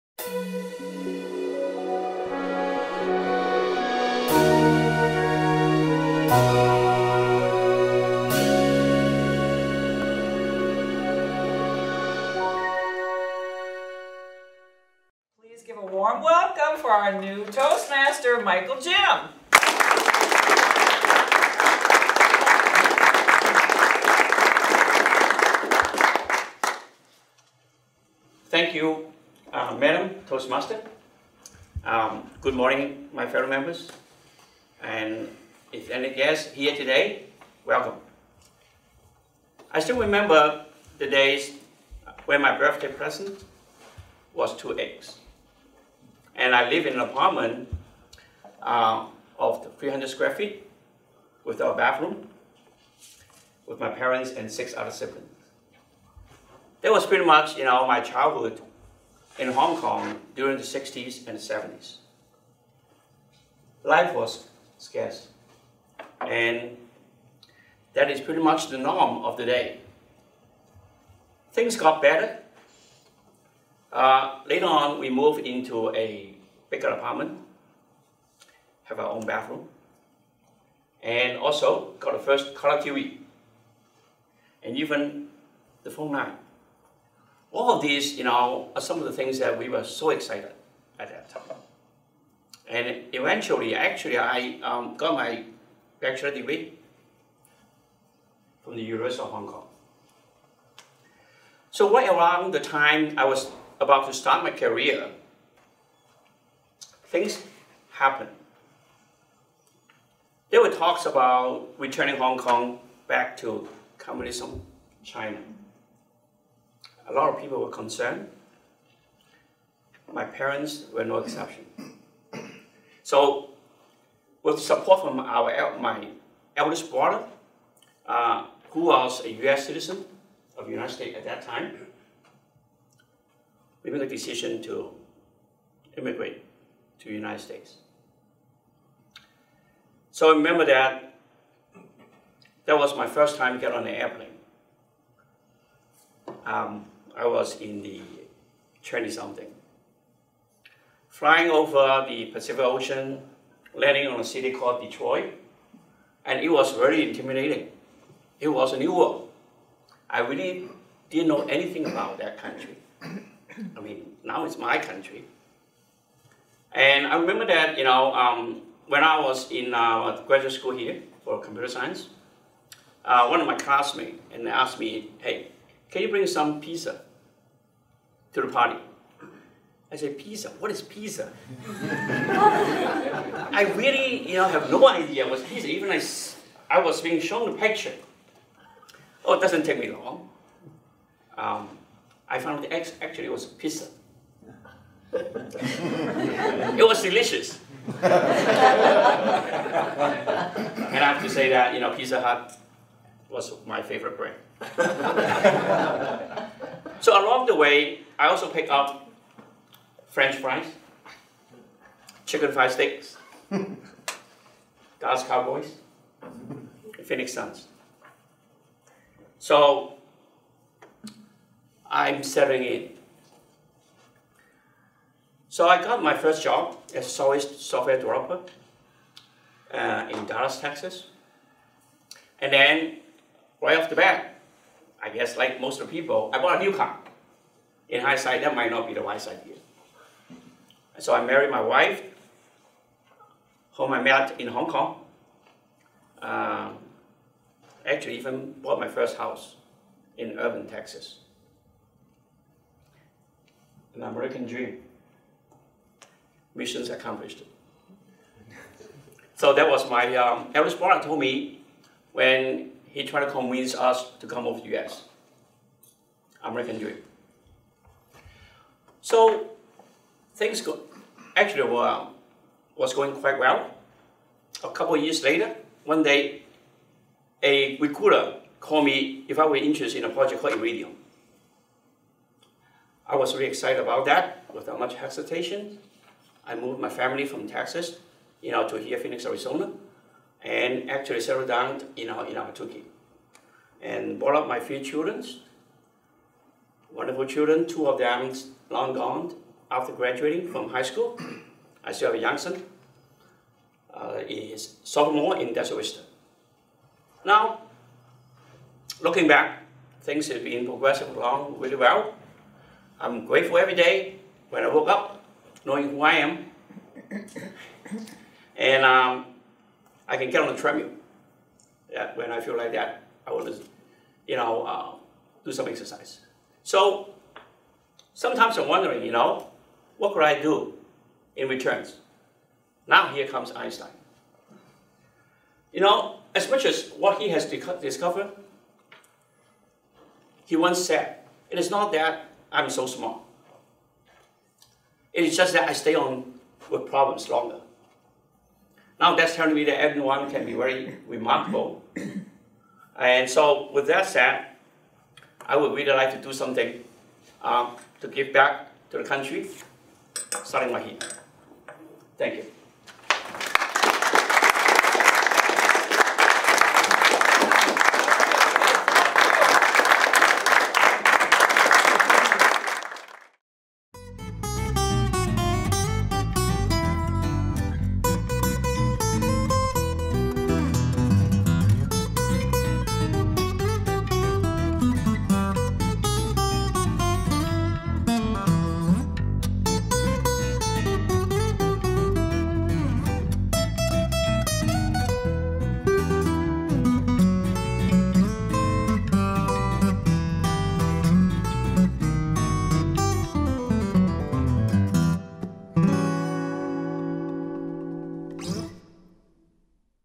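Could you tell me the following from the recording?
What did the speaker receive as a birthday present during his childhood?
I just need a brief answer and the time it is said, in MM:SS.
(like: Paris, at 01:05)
2 eggs, at 00:44.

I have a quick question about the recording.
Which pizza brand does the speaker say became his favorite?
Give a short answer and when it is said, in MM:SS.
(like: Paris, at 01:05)
Pizza Hut, at 03:21.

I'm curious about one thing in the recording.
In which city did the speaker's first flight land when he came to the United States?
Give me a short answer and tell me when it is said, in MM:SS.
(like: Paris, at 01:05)
Detroit, at 02:34.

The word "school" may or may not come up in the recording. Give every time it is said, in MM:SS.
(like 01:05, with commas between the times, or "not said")
02:50, 05:00.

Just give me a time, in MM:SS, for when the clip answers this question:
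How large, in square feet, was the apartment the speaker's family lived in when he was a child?
00:49.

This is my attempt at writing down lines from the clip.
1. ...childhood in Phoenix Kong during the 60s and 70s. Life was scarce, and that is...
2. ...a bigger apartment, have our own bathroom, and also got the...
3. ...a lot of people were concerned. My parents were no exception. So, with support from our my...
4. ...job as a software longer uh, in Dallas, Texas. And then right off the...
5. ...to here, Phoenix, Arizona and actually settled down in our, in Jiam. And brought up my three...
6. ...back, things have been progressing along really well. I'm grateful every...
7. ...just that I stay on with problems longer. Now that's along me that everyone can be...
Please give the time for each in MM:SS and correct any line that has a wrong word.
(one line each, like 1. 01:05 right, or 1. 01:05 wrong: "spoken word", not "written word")
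1. 00:57 wrong: "Hong", not "Phoenix"
2. 01:15 right
3. 01:57 right
4. 03:46 wrong: "developer", not "longer"
5. 04:48 wrong: "Ahwatukee", not "Jiam"
6. 05:09 right
7. 05:45 wrong: "telling", not "along".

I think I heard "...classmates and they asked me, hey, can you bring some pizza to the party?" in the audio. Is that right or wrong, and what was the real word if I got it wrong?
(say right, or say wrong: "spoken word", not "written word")
right.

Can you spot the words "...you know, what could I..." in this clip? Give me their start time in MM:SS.
05:29.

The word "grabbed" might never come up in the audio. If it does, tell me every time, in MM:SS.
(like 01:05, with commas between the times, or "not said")
not said.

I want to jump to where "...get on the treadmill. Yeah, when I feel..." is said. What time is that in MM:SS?
05:20.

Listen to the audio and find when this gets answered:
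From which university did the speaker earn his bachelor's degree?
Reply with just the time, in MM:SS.
01:38.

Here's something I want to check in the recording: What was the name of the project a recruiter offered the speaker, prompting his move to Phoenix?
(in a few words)
Iridium.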